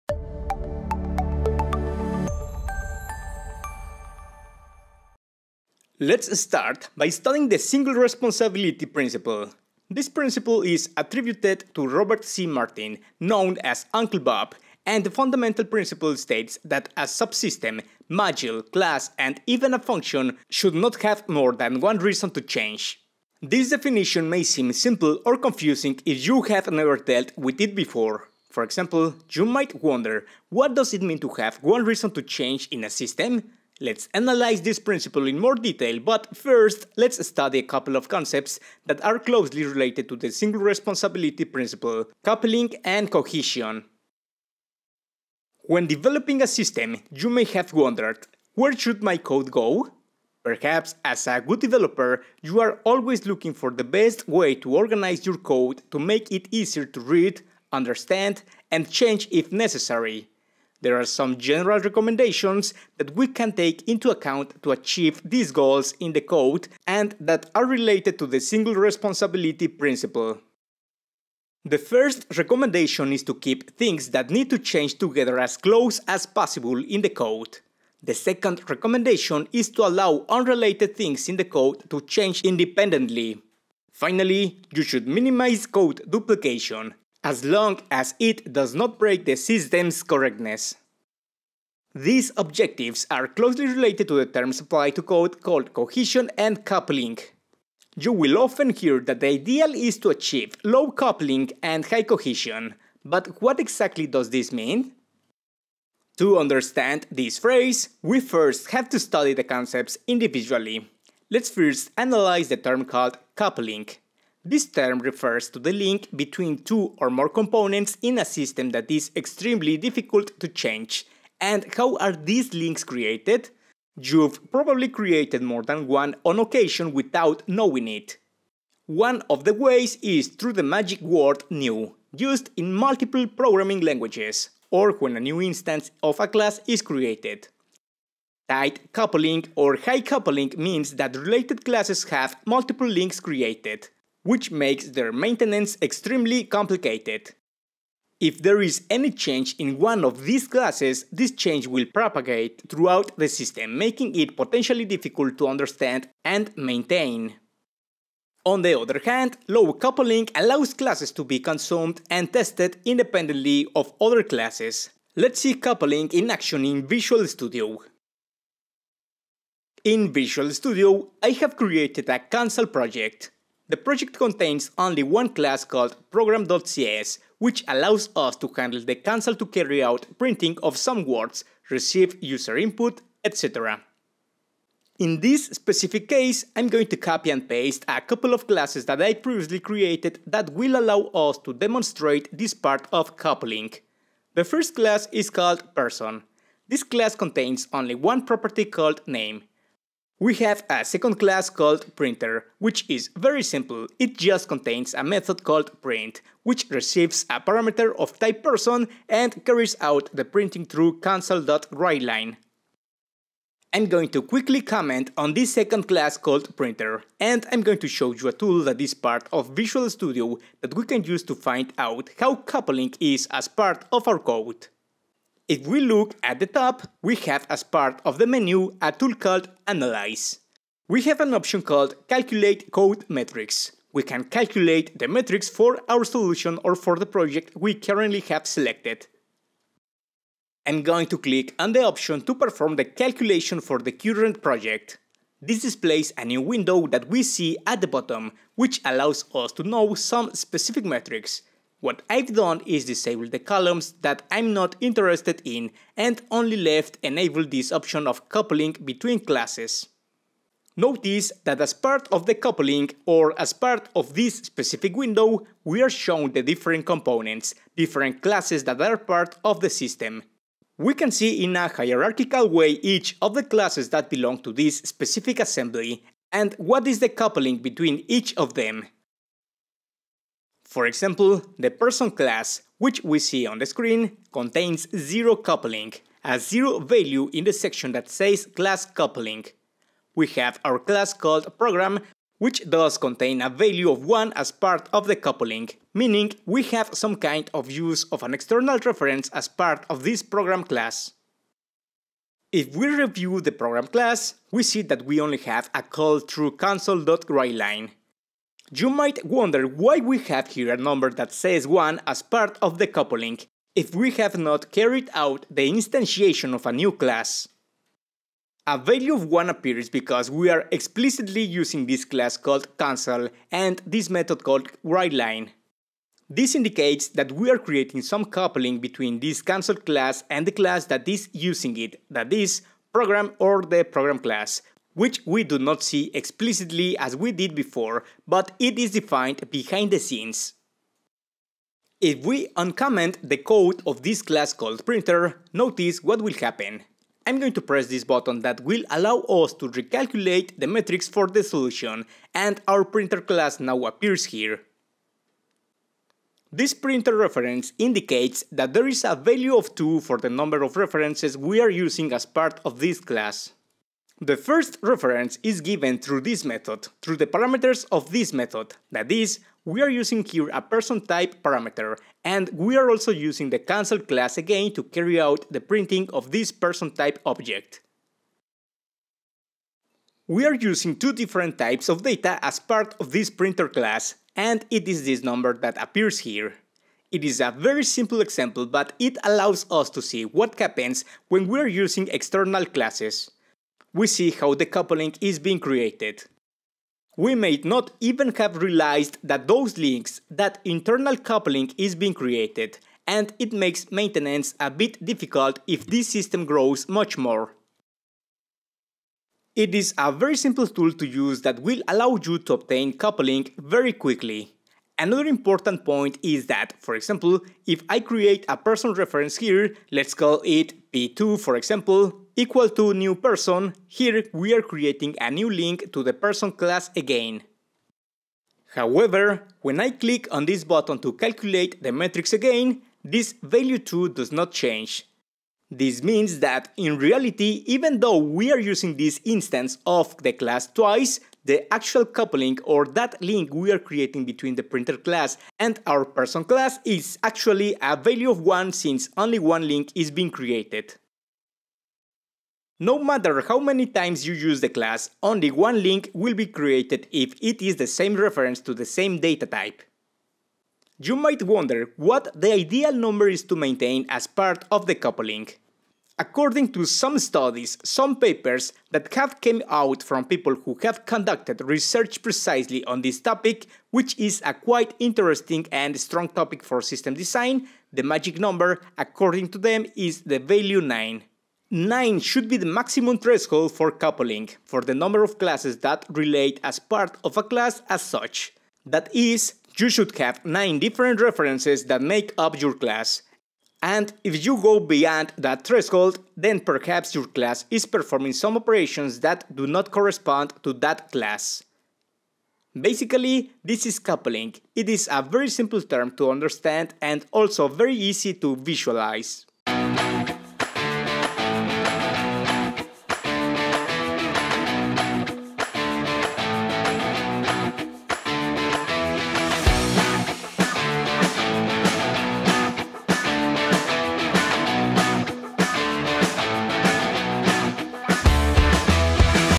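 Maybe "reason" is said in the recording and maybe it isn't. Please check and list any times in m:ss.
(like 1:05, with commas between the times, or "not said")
0:21, 0:31.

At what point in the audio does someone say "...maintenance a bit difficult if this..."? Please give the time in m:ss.
6:43.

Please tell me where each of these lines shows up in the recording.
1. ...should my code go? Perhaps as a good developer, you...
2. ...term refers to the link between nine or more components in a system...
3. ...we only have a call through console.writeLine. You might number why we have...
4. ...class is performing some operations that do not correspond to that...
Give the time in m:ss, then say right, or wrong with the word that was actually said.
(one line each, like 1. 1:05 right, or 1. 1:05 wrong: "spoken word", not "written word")
1. 0:48 right
2. 1:54 wrong: "two", not "nine"
3. 5:05 wrong: "wonder", not "number"
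4. 8:17 right.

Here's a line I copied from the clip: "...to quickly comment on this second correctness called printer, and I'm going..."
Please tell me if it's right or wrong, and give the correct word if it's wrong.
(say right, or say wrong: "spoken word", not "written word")
wrong: "class", not "correctness".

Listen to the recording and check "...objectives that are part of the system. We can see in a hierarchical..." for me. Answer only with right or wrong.
wrong.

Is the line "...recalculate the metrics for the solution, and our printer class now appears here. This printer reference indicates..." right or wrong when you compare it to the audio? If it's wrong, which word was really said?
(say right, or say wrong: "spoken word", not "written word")
right.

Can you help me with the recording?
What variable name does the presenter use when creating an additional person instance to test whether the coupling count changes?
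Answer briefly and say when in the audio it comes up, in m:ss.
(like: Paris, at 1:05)
P2, at 7:00.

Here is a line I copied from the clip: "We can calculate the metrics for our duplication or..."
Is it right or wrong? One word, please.
wrong.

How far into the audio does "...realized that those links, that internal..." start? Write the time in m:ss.
6:38.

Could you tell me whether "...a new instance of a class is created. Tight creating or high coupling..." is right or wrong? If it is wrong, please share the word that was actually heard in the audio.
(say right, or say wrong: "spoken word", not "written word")
wrong: "coupling", not "creating".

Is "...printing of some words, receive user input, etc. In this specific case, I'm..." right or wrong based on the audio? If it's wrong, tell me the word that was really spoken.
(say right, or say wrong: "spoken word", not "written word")
right.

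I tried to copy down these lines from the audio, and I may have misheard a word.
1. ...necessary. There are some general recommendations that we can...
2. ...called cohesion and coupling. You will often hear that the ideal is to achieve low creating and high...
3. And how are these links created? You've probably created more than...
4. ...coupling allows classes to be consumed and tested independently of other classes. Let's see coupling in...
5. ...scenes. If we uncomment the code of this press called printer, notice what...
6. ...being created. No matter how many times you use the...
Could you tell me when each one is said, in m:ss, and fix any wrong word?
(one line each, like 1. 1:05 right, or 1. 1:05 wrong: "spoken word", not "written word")
1. 0:59 right
2. 1:35 wrong: "coupling", not "creating"
3. 2:01 right
4. 2:39 right
5. 5:39 wrong: "class", not "press"
6. 7:30 right.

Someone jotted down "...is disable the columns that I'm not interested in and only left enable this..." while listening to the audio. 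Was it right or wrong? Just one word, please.
right.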